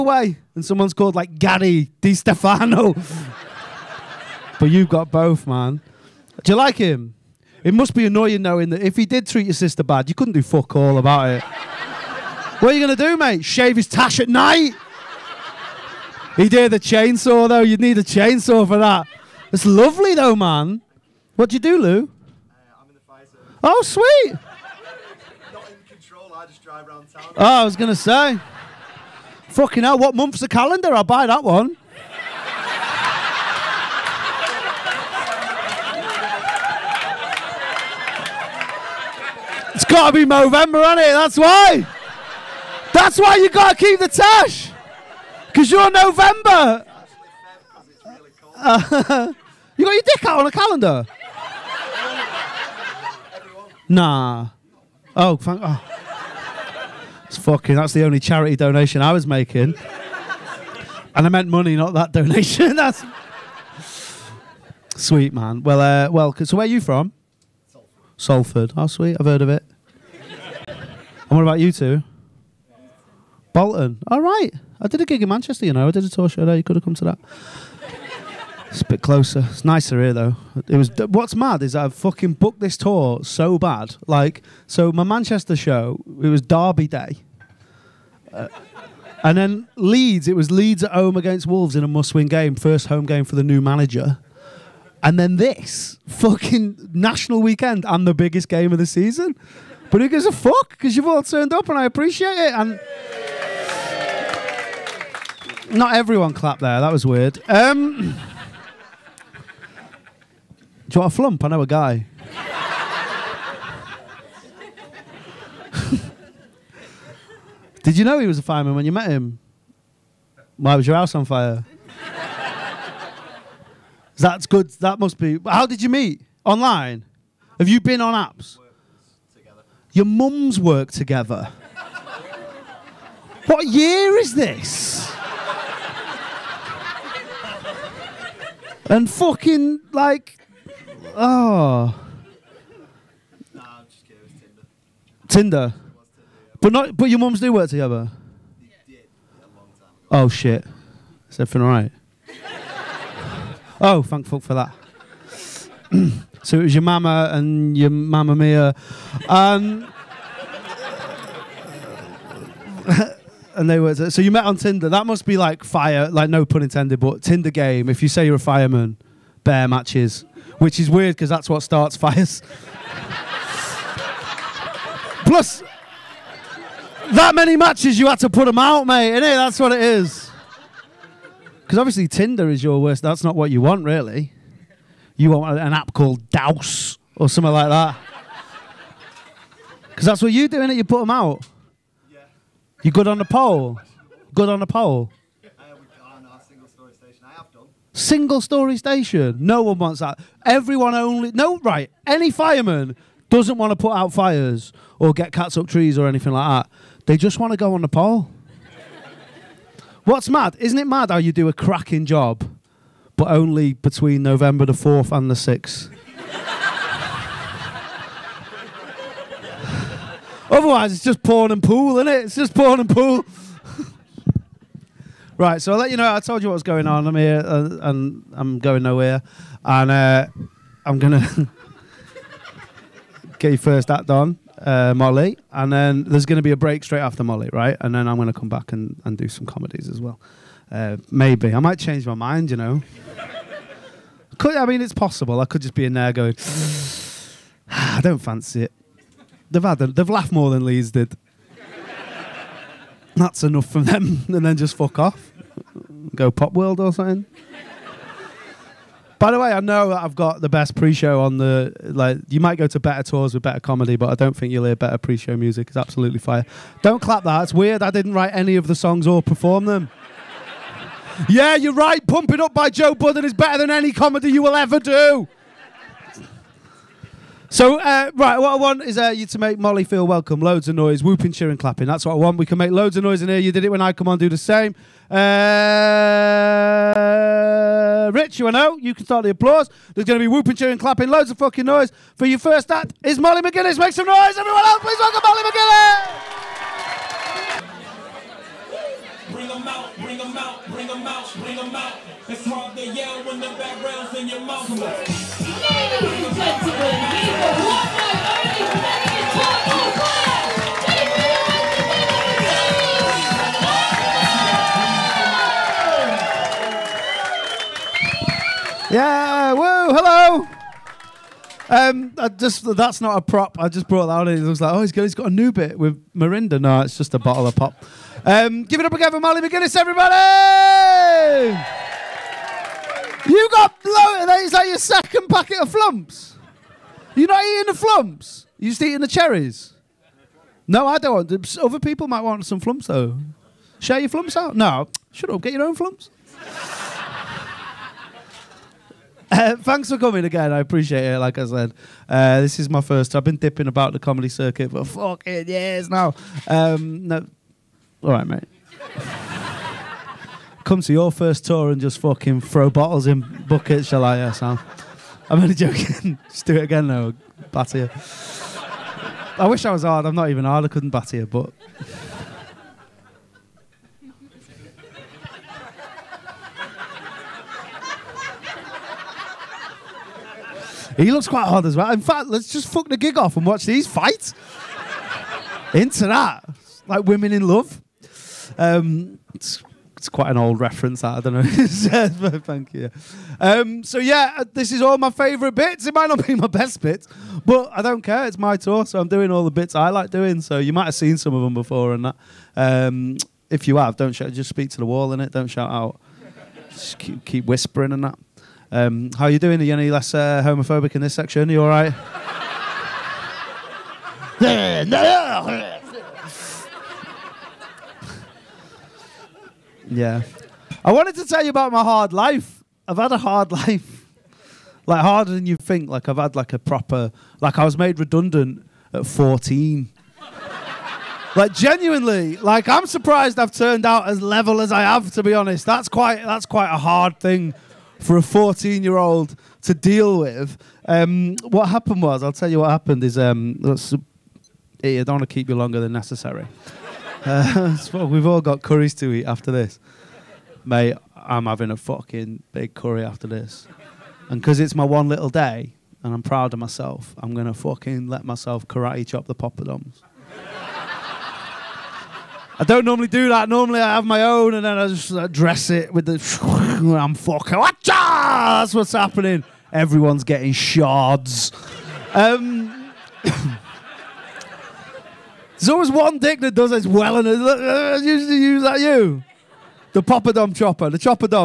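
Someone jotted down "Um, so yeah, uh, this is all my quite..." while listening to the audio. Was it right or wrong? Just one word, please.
wrong.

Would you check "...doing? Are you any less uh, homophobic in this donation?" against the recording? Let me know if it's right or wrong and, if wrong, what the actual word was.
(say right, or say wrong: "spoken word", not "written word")
wrong: "section", not "donation".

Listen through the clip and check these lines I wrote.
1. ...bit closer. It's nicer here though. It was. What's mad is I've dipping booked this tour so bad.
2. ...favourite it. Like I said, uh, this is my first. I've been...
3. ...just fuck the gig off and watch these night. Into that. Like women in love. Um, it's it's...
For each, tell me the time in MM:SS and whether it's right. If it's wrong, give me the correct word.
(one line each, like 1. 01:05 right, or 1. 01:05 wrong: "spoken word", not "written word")
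1. 01:18 wrong: "fucking", not "dipping"
2. 05:50 wrong: "appreciate", not "favourite"
3. 06:22 wrong: "fight", not "night".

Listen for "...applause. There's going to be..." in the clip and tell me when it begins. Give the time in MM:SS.
04:49.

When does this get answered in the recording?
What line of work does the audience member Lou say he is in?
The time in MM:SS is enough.
00:23.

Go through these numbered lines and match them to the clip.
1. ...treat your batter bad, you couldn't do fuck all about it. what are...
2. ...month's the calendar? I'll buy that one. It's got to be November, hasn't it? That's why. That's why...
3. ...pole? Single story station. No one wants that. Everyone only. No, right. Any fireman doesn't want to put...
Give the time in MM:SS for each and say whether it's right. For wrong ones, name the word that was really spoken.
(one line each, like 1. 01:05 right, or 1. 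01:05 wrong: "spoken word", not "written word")
1. 00:09 wrong: "sister", not "batter"
2. 00:30 right
3. 03:14 right.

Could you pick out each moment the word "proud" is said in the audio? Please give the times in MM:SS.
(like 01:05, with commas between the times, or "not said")
07:36.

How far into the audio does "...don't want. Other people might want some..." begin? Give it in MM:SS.
05:40.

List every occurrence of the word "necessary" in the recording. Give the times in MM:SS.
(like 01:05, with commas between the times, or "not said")
07:25.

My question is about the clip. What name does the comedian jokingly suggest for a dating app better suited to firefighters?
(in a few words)
Douse.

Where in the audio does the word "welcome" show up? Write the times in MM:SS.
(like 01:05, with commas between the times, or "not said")
04:40, 04:54.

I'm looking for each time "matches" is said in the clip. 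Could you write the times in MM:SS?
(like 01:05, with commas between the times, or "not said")
02:49, 02:57.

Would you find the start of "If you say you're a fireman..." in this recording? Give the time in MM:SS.
02:47.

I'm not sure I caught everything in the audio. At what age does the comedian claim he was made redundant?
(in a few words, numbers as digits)
14.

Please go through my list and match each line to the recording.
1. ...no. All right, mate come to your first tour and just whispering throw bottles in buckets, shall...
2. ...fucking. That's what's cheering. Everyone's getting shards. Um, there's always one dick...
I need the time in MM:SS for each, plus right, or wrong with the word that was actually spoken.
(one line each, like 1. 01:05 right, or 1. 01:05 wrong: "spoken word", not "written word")
1. 05:57 wrong: "fucking", not "whispering"
2. 07:47 wrong: "happening", not "cheering".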